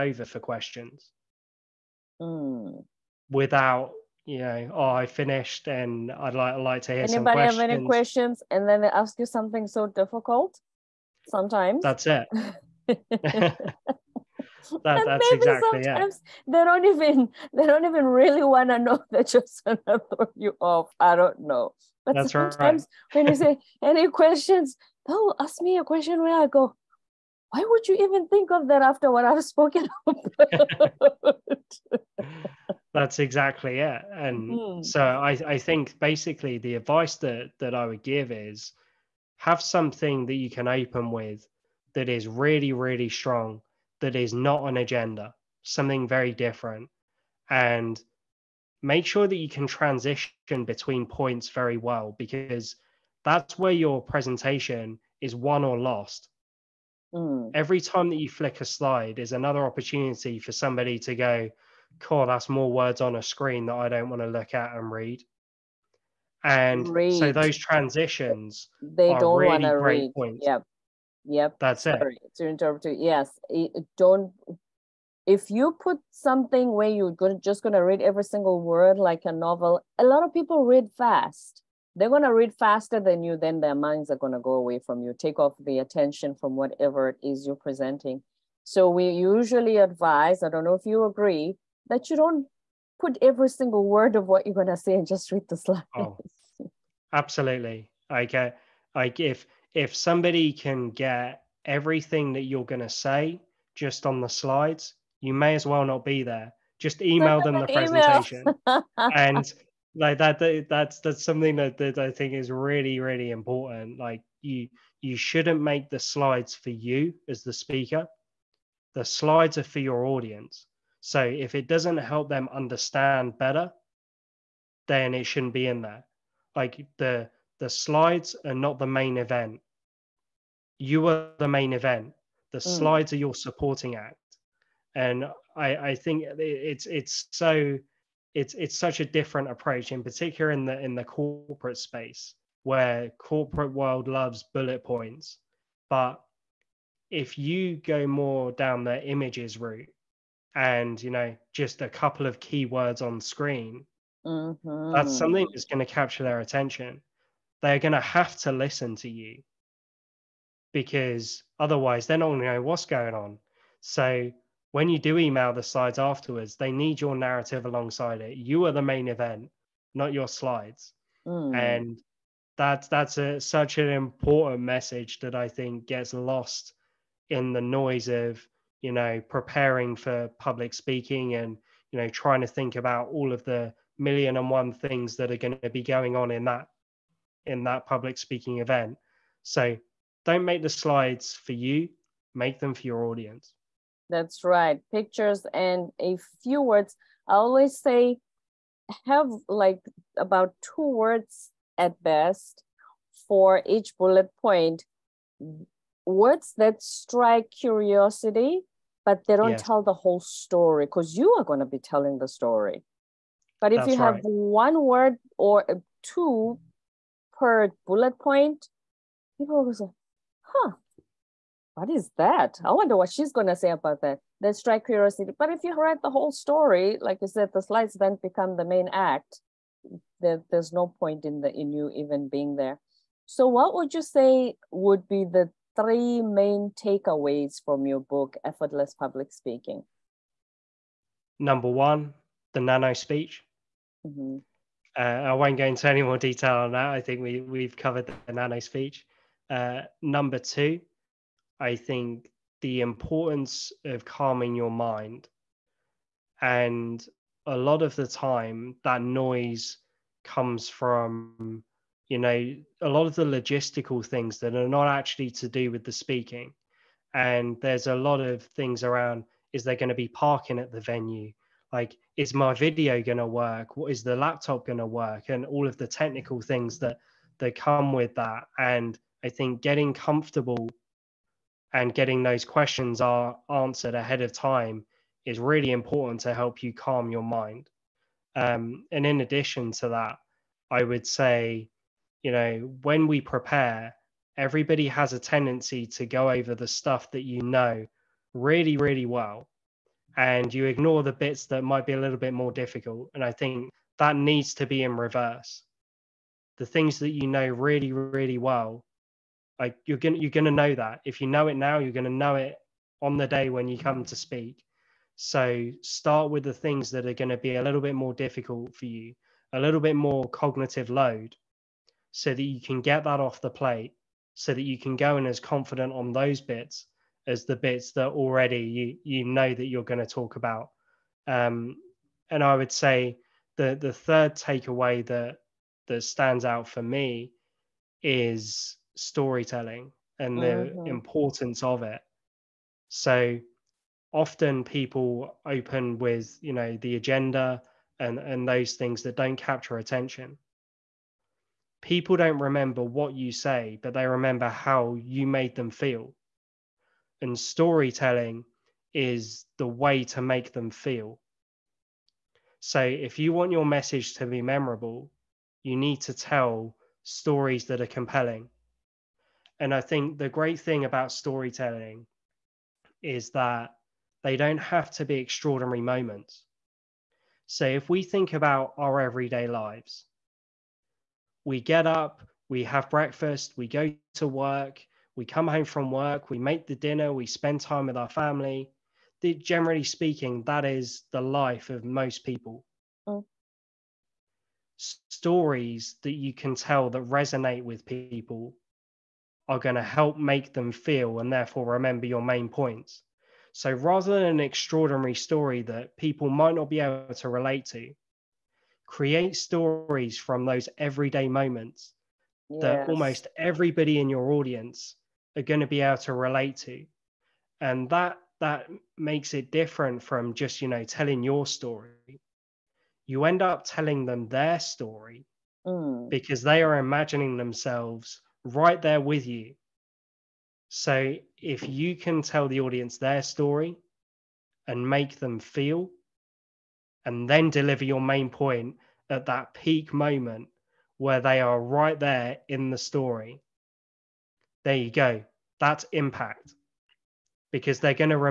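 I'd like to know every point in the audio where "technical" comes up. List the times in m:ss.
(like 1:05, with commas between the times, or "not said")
4:35.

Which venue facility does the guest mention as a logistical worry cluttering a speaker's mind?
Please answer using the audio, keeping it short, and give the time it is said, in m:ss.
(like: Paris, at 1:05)
parking, at 4:30.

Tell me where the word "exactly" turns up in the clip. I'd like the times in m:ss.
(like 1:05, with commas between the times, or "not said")
0:15, 0:33.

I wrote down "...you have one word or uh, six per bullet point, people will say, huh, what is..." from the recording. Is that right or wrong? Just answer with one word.
wrong.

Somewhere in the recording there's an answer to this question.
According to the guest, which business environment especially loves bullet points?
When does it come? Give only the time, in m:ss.
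2:23.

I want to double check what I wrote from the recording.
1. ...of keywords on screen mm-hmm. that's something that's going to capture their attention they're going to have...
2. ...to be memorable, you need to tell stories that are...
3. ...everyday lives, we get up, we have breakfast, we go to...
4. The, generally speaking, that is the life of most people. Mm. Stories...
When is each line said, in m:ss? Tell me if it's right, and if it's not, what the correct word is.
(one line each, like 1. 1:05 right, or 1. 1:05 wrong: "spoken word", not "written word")
1. 2:32 right
2. 6:04 right
3. 6:18 right
4. 6:29 right.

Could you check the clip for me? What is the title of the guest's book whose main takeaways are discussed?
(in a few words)
Effortless Public Speaking.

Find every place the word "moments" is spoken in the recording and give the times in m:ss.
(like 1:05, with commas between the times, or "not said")
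6:15, 6:51, 7:19.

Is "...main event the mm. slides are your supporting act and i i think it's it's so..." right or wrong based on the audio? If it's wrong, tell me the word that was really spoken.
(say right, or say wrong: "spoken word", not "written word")
right.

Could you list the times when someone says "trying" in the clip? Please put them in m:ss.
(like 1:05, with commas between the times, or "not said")
3:02.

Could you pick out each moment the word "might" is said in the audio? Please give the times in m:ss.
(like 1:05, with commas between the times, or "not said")
5:01, 6:46.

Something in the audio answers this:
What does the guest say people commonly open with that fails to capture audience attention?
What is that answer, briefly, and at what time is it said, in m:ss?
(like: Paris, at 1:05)
the agenda, at 5:46.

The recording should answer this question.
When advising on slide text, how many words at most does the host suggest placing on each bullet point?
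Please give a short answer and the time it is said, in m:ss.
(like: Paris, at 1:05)
2, at 3:20.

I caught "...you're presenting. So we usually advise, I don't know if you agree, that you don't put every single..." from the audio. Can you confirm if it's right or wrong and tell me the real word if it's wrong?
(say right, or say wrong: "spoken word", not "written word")
right.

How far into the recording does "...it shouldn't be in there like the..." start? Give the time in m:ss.
2:05.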